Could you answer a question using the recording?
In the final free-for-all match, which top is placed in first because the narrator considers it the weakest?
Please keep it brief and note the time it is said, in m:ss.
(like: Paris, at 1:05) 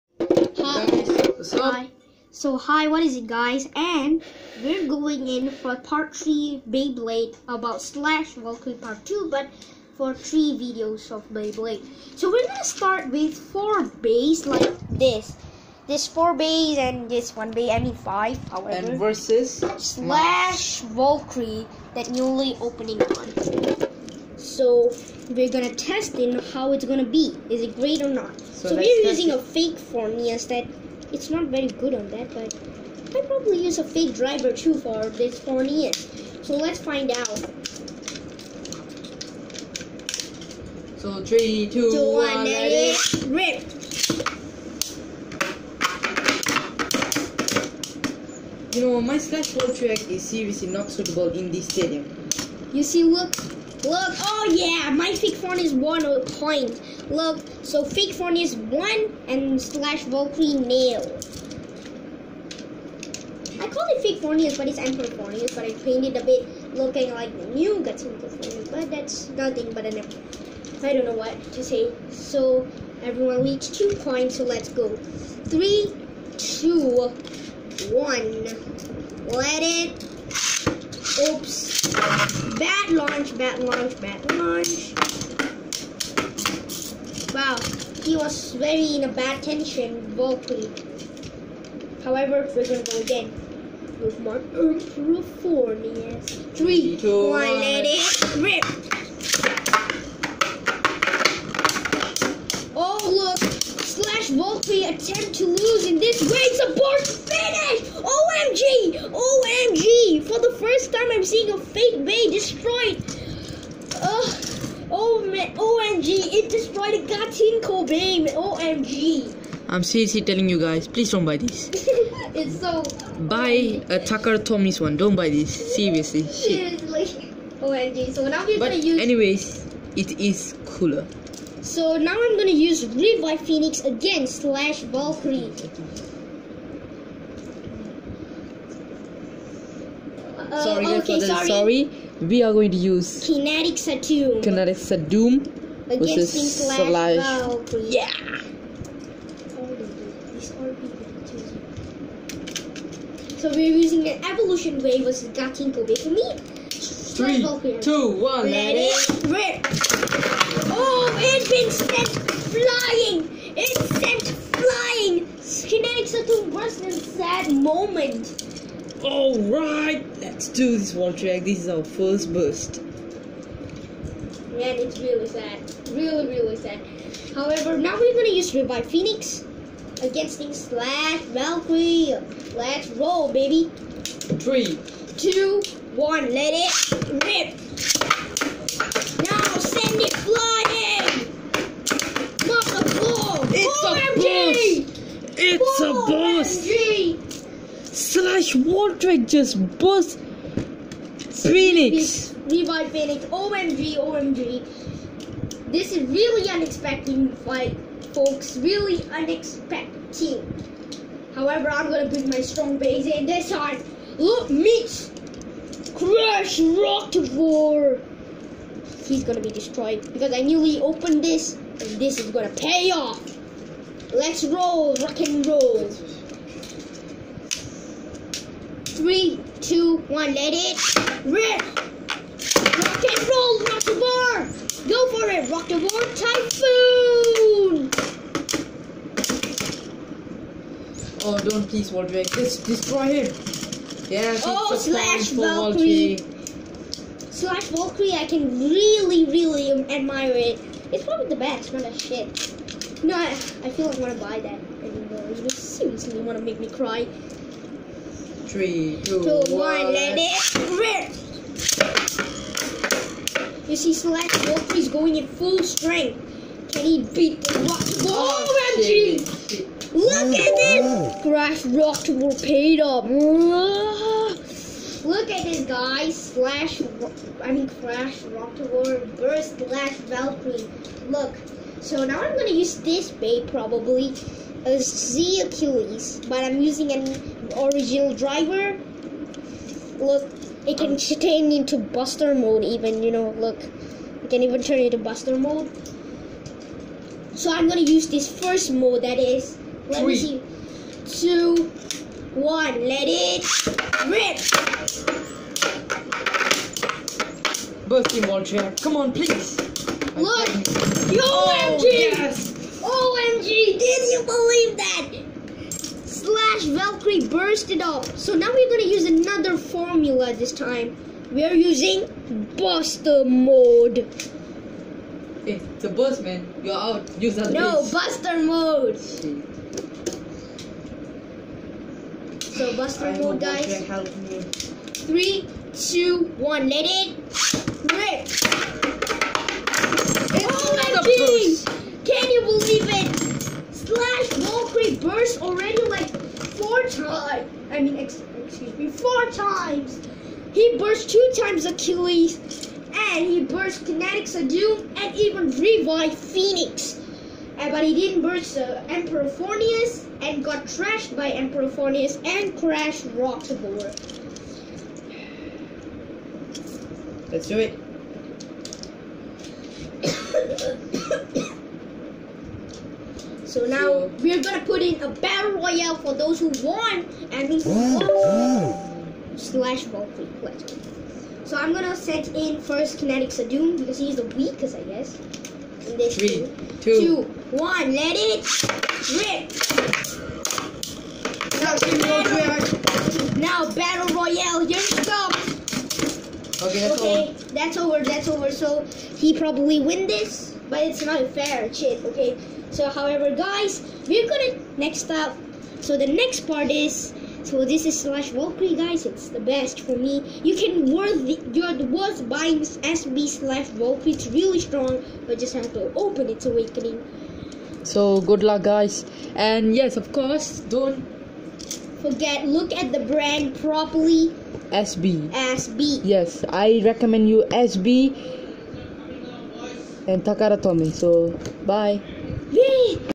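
Kinetic Doom, at 6:22.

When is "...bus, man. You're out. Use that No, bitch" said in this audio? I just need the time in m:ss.
5:25.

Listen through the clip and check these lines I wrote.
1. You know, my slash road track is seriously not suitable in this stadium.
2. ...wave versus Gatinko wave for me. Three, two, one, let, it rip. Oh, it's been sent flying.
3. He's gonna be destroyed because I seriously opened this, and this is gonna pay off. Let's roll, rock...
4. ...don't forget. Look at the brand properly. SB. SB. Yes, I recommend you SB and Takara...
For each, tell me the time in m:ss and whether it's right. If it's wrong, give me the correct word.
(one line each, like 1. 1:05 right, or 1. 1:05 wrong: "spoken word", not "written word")
1. 0:48 right
2. 2:34 right
3. 3:39 wrong: "newly", not "seriously"
4. 7:00 right.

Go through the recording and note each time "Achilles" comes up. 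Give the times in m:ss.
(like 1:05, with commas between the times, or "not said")
4:45, 5:51.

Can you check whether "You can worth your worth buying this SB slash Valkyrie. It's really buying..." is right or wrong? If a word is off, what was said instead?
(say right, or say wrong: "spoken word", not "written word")
wrong: "strong", not "buying".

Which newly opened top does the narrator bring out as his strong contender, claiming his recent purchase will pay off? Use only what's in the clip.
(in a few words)
Crash Roktavor.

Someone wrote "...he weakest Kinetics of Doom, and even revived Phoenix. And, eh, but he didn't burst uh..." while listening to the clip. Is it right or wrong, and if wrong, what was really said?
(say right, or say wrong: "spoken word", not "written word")
wrong: "burst", not "weakest".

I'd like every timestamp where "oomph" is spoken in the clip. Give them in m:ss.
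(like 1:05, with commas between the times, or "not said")
1:34.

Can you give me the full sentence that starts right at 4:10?
It's probably the best, not a shit.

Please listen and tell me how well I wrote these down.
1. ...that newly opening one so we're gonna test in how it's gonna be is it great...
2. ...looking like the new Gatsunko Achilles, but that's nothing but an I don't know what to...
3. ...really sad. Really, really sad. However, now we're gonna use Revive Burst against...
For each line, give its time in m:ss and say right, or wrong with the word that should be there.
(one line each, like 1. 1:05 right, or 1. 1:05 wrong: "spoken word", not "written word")
1. 0:21 right
2. 1:06 wrong: "Forneus", not "Achilles"
3. 2:54 wrong: "Phoenix", not "Burst".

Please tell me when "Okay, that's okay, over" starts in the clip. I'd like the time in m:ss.
6:36.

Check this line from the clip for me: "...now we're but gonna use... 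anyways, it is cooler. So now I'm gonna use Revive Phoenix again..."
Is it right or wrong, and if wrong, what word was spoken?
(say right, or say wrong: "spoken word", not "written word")
right.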